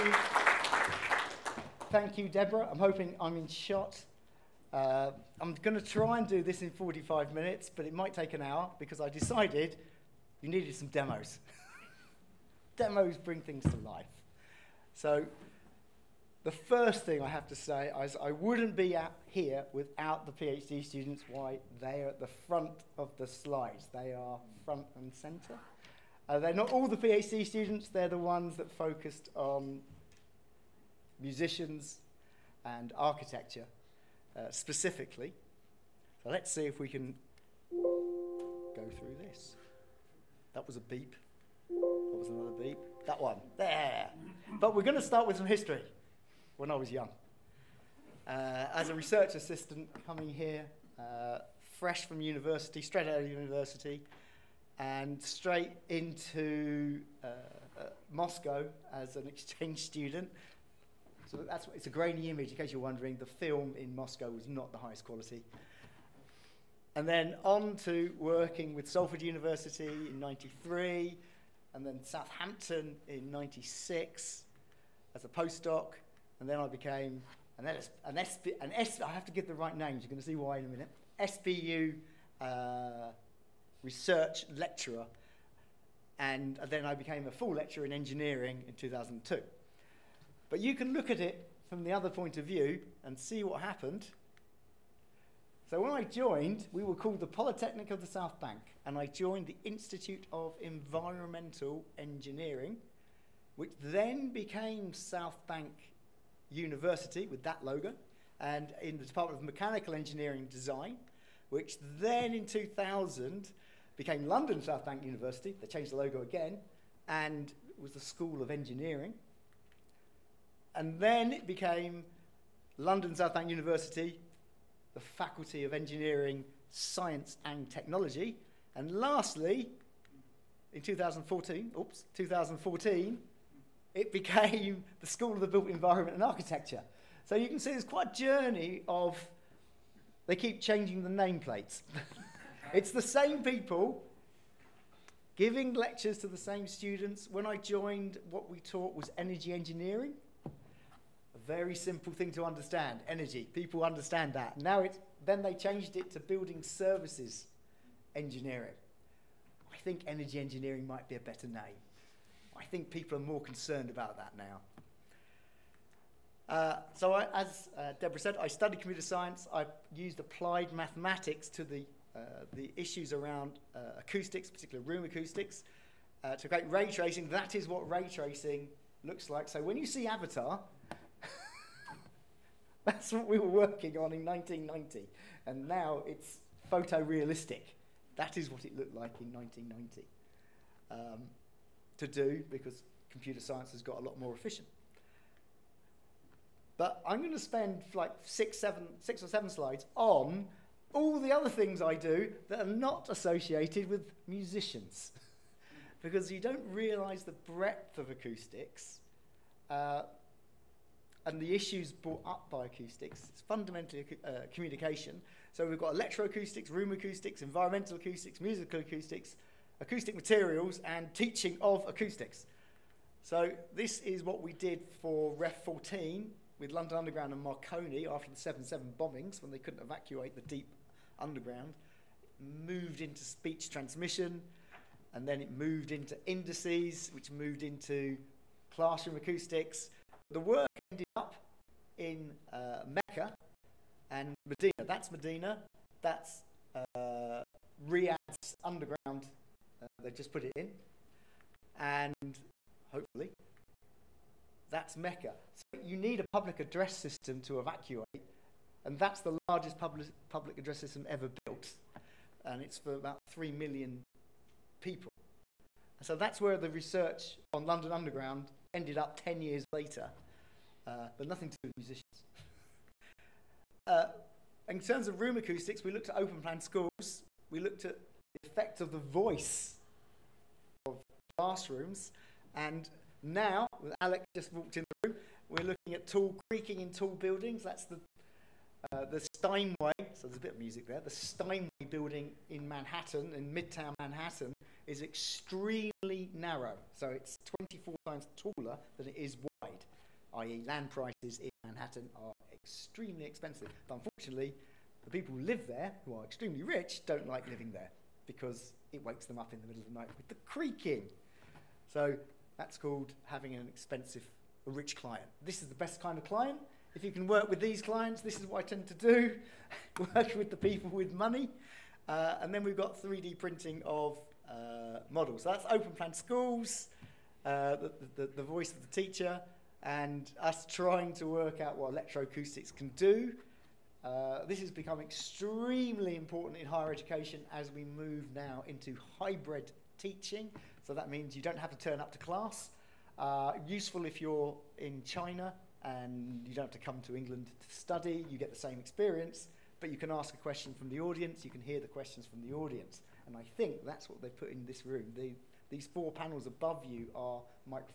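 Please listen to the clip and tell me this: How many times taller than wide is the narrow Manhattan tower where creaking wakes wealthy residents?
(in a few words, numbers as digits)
24.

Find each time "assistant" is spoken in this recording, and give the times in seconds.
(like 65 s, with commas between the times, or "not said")
49 s.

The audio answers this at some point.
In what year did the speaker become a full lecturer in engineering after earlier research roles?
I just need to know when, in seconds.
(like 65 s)
88 s.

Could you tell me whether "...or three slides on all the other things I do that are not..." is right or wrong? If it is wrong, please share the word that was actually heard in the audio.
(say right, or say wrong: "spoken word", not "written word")
wrong: "seven", not "three".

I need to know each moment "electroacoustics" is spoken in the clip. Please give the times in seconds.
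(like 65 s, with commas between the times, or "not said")
215 s, 331 s.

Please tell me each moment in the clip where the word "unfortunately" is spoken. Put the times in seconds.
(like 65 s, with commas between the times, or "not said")
303 s.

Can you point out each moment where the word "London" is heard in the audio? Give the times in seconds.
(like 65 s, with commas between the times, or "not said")
114 s, 122 s, 226 s, 267 s.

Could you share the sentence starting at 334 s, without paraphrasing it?
Uh, this has become extremely important in higher education as we move now into hybrid teaching.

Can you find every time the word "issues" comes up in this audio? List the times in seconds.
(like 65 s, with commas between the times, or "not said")
172 s, 211 s.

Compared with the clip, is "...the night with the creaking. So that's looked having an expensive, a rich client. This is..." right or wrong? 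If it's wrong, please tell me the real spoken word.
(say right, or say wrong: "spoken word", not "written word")
wrong: "called", not "looked".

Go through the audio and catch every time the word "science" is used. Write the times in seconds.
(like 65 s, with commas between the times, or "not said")
126 s, 169 s, 193 s.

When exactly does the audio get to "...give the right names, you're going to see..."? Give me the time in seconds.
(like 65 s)
79 s.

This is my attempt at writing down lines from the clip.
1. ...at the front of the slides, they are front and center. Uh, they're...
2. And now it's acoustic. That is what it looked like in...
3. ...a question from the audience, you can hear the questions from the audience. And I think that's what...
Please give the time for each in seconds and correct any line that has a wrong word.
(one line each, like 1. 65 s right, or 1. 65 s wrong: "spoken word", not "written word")
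1. 22 s right
2. 185 s wrong: "photorealistic", not "acoustic"
3. 350 s right.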